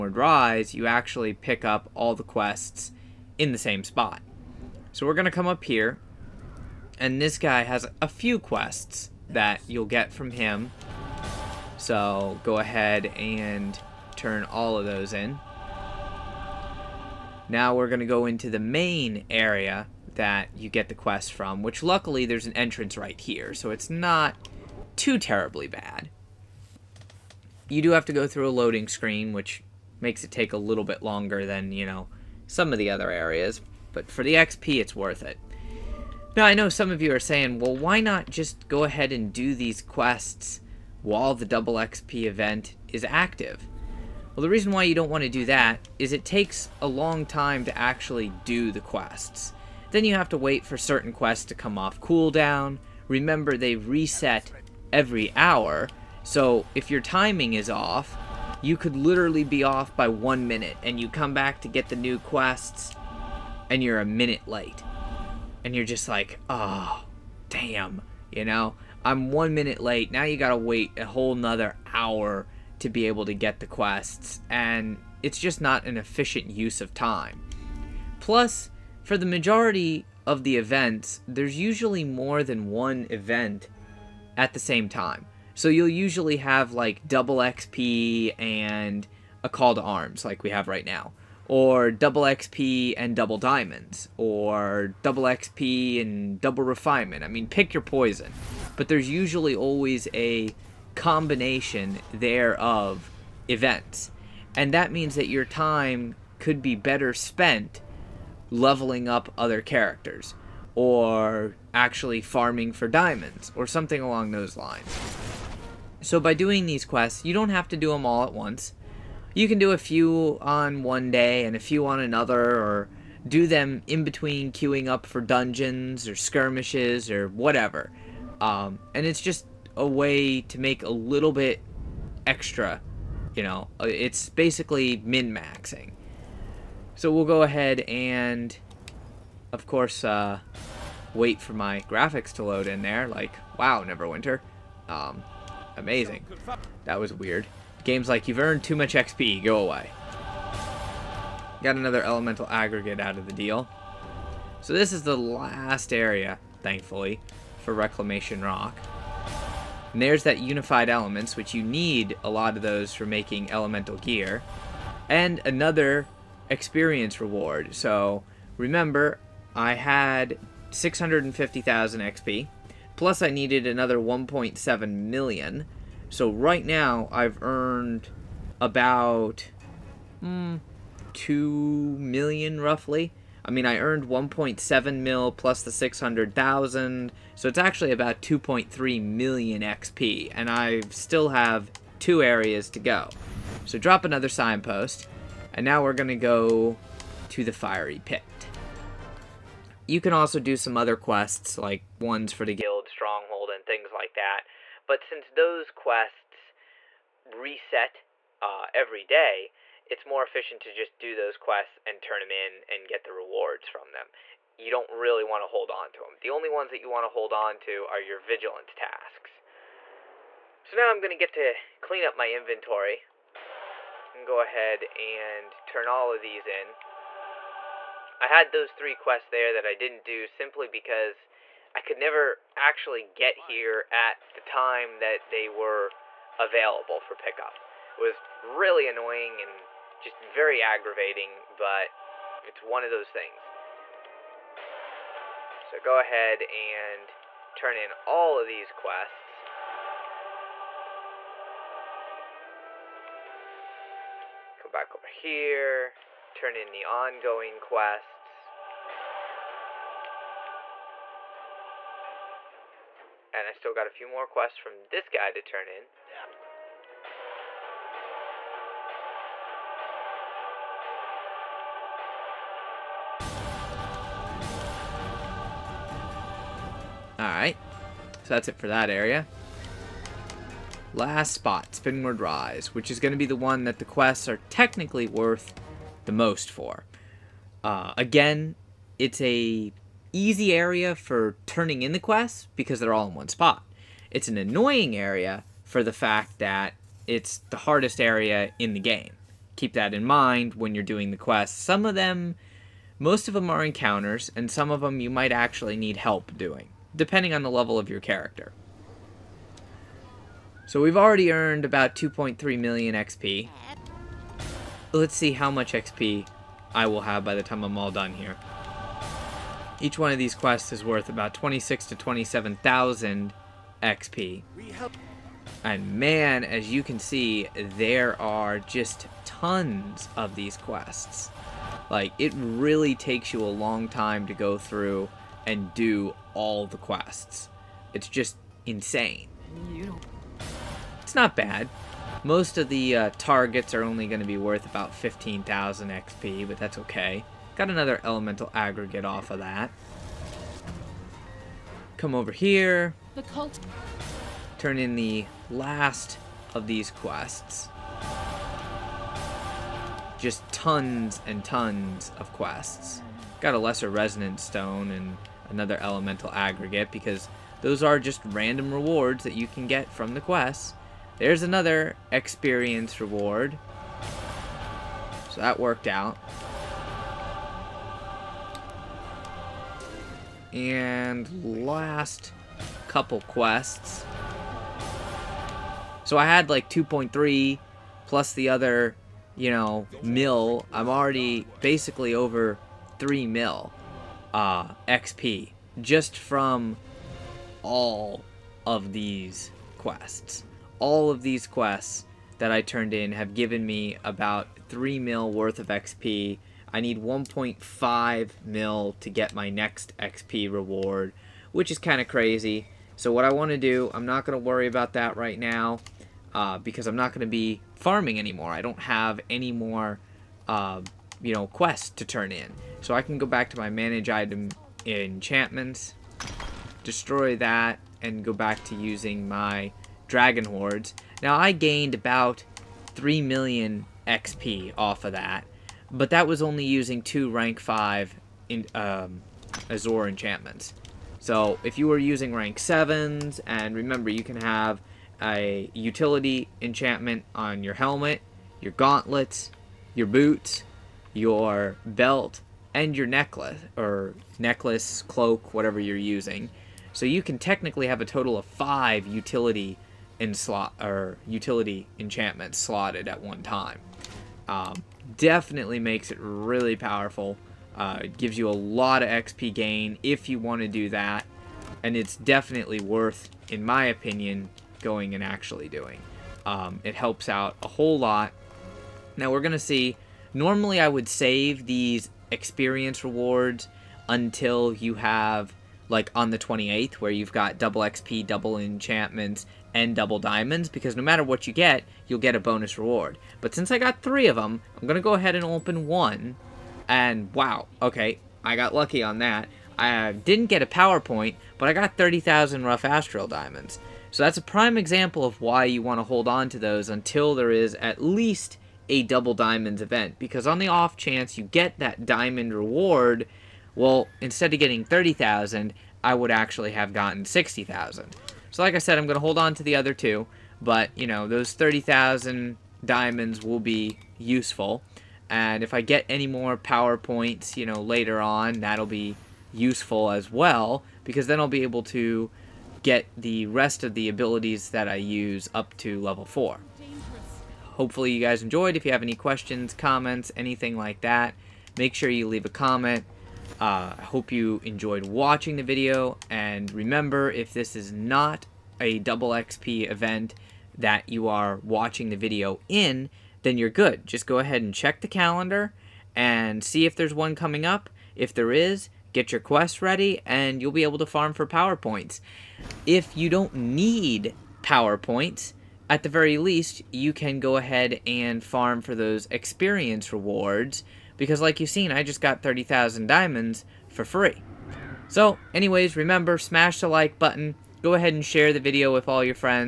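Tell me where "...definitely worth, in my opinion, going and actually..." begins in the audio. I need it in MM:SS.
07:52.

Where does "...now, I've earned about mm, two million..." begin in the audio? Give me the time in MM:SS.
02:56.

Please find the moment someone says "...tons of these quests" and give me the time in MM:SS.
05:29.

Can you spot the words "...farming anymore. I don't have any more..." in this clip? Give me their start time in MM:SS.
06:57.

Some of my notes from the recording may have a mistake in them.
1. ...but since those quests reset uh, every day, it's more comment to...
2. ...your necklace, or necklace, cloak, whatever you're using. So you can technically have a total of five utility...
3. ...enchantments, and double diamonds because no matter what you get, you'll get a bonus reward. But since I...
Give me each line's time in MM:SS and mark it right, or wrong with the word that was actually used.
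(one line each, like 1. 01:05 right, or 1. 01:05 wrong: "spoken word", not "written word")
1. 03:24 wrong: "efficient", not "comment"
2. 07:32 right
3. 08:08 right.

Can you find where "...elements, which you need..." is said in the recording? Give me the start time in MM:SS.
02:40.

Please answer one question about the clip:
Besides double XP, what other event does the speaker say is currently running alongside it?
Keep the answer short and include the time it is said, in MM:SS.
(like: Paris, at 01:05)
Call to arms, at 01:29.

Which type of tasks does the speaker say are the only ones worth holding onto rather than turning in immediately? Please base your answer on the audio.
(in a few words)
Vigilance tasks.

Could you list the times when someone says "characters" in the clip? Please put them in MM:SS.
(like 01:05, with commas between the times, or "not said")
01:49, 05:08.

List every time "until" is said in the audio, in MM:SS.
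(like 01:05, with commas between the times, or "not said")
08:04, 08:26.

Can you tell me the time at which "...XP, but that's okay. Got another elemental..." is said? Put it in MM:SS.
05:45.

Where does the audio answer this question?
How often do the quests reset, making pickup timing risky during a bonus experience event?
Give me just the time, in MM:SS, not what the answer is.
00:53.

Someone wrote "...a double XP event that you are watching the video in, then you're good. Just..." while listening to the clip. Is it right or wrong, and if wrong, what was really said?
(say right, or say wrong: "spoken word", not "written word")
right.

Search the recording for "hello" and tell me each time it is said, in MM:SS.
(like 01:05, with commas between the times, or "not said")
not said.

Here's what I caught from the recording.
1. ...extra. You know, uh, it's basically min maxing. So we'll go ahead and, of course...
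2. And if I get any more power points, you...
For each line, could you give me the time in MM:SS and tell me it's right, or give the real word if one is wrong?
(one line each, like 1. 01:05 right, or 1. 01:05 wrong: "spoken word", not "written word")
1. 02:12 right
2. 08:45 right.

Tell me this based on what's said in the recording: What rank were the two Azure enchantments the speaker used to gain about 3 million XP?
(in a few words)
Rank 5.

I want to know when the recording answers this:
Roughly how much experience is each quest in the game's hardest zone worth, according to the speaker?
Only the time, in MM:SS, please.
05:21.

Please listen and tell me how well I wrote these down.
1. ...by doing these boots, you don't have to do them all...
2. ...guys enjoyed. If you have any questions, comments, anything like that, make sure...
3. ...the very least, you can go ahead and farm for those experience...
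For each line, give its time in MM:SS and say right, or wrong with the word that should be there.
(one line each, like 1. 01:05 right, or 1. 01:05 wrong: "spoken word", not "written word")
1. 01:56 wrong: "quests", not "boots"
2. 08:58 right
3. 09:26 right.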